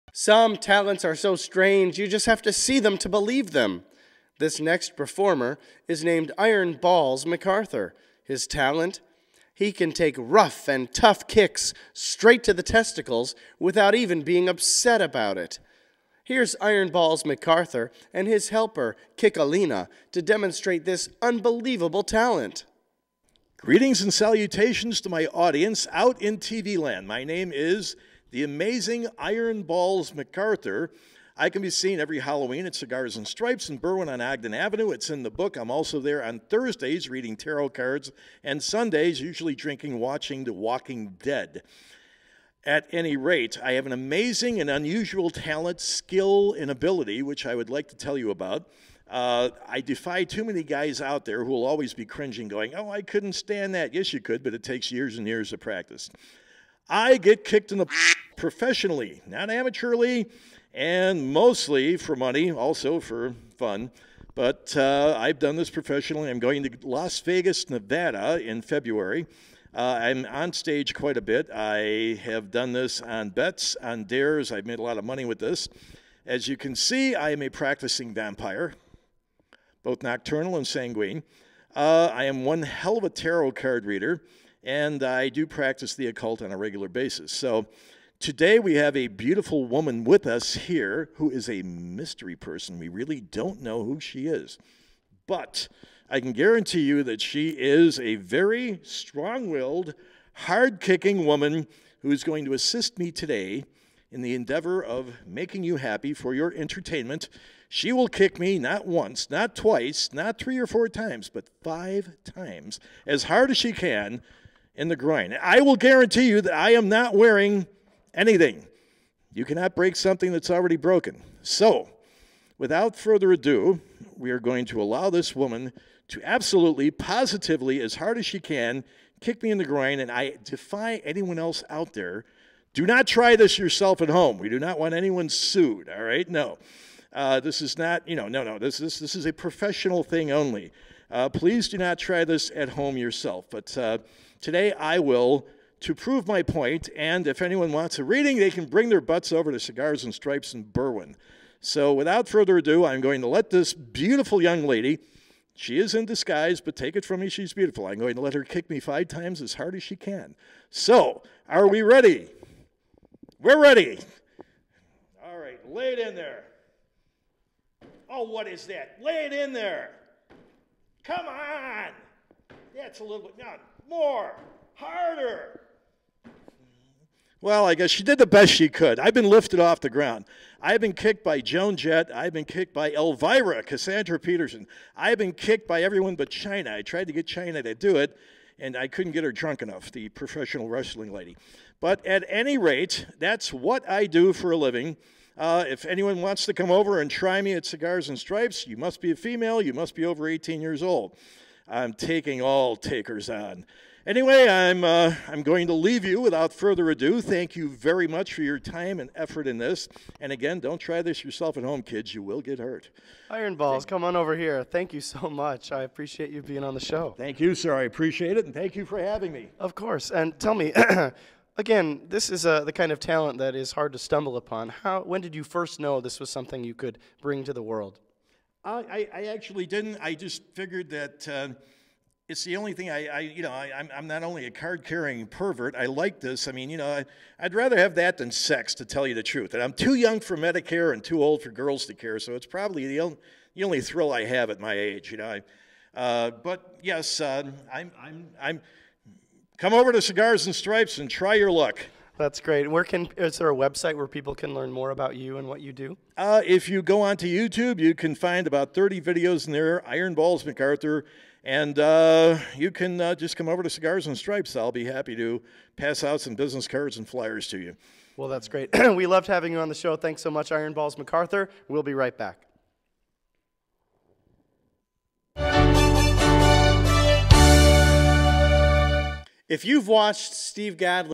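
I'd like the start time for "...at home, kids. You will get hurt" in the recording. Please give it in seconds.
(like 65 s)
211 s.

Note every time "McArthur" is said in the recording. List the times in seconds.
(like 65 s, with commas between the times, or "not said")
7 s, 17 s, 30 s.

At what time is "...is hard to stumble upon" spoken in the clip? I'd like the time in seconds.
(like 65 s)
223 s.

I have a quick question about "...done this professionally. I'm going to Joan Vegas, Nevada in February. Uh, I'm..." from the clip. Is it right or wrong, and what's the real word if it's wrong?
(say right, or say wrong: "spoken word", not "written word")
wrong: "Las", not "Joan".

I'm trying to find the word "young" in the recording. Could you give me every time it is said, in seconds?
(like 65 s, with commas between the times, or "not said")
154 s, 239 s.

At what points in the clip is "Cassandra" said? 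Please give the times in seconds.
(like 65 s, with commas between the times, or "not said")
183 s.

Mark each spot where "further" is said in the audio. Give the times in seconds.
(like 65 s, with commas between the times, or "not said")
122 s, 152 s, 206 s.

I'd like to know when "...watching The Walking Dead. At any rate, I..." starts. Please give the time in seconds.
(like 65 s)
39 s.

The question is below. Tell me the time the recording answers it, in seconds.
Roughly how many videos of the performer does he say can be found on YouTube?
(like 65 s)
258 s.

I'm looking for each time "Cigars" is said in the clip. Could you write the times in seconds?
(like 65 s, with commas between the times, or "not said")
32 s, 149 s, 197 s, 250 s, 263 s.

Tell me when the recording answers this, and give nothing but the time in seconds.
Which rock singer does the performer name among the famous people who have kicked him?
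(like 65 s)
181 s.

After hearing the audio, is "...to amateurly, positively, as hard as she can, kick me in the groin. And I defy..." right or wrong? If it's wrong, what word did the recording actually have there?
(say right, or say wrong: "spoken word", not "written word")
wrong: "absolutely", not "amateurly".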